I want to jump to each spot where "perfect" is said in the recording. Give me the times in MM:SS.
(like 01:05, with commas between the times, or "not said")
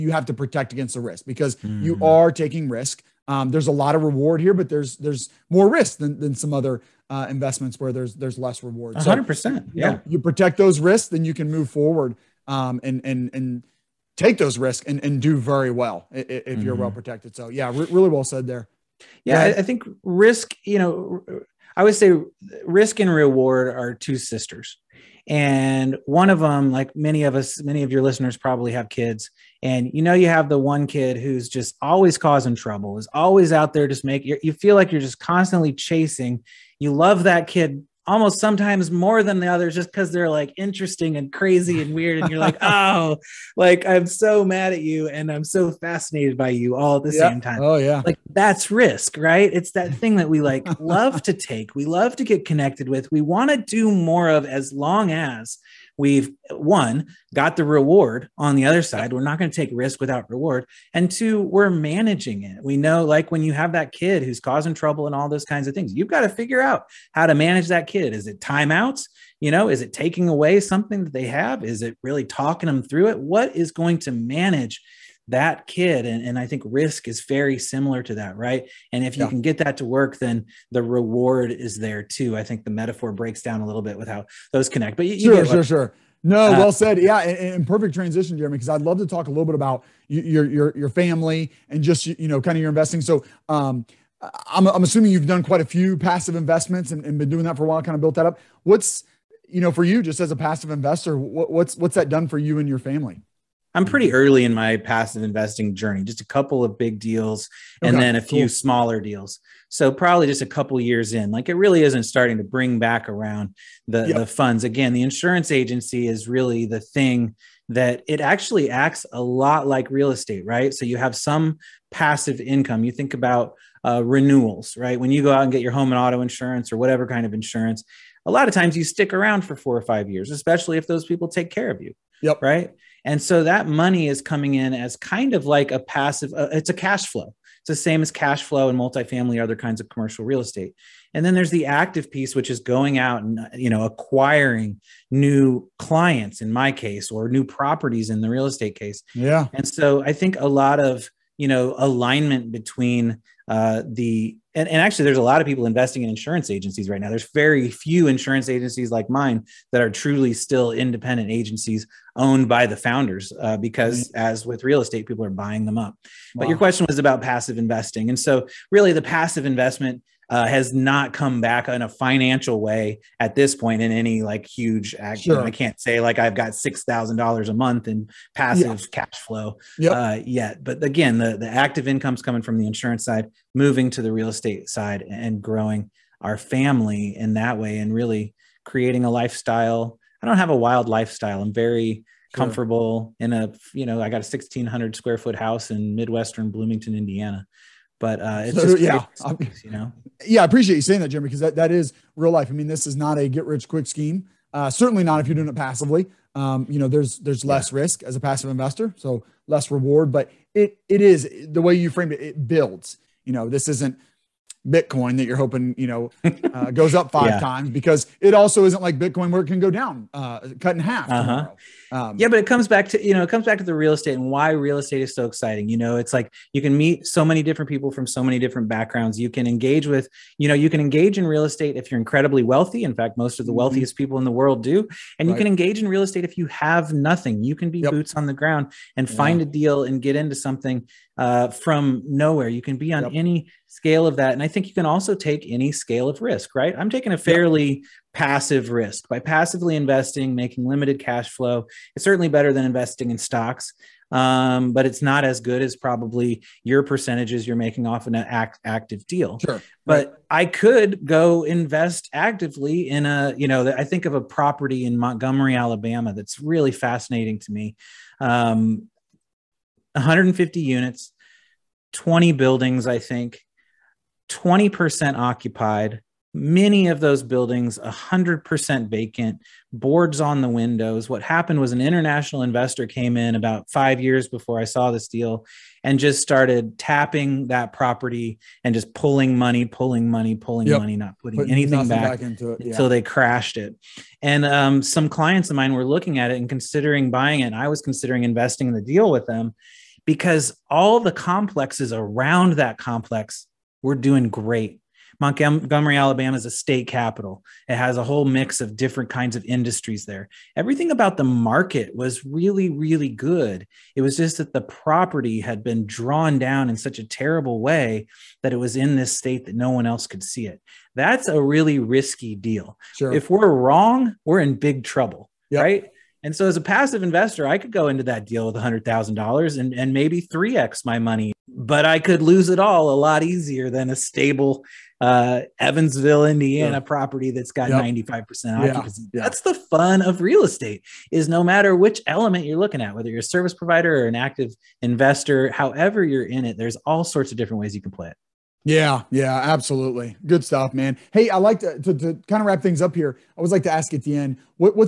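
01:27.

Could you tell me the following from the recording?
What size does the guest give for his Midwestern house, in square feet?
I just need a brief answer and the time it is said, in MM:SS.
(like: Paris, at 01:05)
1600, at 03:14.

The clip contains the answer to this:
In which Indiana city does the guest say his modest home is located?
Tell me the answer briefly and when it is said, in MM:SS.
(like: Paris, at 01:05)
Bloomington, at 03:16.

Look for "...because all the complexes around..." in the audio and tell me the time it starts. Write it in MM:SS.
05:00.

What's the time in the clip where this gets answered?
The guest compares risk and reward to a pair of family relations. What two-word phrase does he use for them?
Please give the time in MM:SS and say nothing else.
00:23.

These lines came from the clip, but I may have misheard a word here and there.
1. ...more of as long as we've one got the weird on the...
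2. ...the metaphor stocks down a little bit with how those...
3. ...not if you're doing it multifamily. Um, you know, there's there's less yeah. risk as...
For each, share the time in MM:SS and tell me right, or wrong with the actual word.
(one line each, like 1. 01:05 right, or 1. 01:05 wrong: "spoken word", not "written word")
1. 00:53 wrong: "reward", not "weird"
2. 01:22 wrong: "breaks", not "stocks"
3. 03:25 wrong: "passively", not "multifamily".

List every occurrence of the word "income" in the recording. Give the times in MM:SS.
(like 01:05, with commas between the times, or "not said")
02:02, 03:01.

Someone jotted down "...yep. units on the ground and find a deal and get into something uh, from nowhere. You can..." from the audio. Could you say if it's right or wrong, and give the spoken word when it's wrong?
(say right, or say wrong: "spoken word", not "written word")
wrong: "boots", not "units".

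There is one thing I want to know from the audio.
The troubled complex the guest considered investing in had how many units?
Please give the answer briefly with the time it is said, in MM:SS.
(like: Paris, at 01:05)
150, at 04:29.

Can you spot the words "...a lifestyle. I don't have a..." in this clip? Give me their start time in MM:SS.
03:09.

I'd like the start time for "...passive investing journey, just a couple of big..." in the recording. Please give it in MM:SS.
01:44.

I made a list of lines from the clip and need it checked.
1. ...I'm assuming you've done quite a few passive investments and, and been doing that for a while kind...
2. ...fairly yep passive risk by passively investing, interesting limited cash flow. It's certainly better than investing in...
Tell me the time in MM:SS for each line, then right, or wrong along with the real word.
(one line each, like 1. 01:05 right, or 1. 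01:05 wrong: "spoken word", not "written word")
1. 01:34 right
2. 04:07 wrong: "making", not "interesting".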